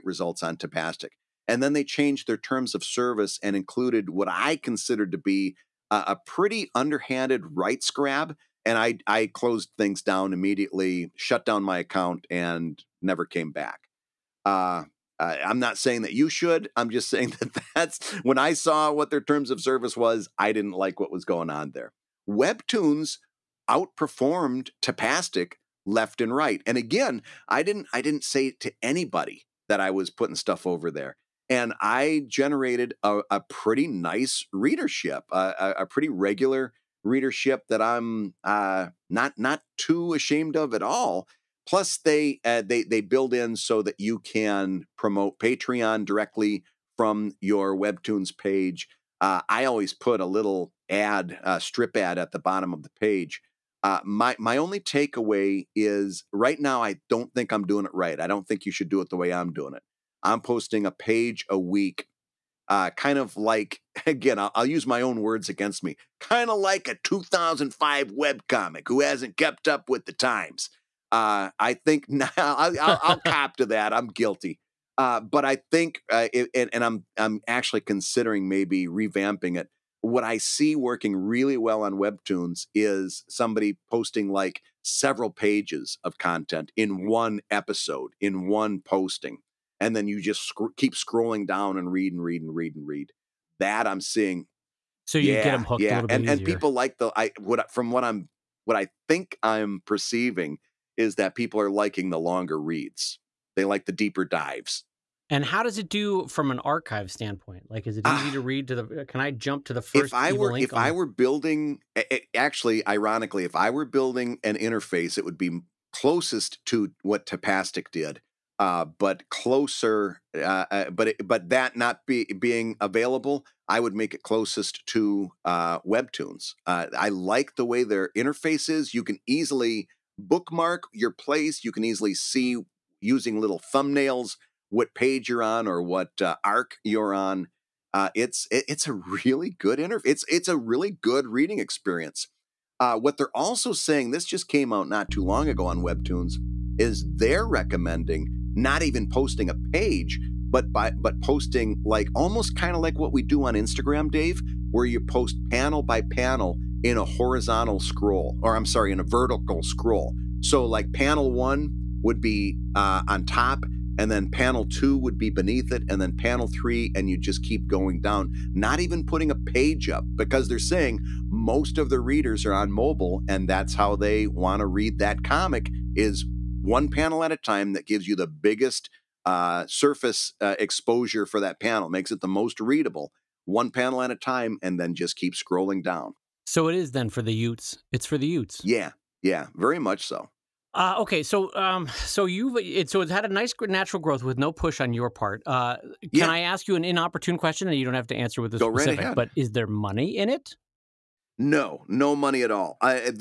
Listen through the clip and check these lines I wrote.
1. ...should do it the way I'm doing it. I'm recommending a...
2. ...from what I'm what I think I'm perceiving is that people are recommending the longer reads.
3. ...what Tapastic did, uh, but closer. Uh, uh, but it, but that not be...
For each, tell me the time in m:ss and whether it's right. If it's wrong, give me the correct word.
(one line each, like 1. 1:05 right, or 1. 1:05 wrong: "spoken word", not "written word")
1. 0:58 wrong: "posting", not "recommending"
2. 1:37 wrong: "liking", not "recommending"
3. 1:57 right.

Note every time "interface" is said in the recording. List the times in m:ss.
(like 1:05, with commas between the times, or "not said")
1:54, 2:08, 2:19.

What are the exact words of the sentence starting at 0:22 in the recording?
Webtoons outperformed Tapastic left and right.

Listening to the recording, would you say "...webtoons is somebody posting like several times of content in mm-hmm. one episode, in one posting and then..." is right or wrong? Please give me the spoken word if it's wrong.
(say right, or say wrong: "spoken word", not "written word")
wrong: "pages", not "times".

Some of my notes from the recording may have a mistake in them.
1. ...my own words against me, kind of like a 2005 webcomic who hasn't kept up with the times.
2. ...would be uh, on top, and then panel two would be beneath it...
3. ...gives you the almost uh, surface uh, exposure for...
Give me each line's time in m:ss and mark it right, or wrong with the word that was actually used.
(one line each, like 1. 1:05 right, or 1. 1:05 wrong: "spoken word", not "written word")
1. 1:04 right
2. 2:42 right
3. 2:57 wrong: "biggest", not "almost".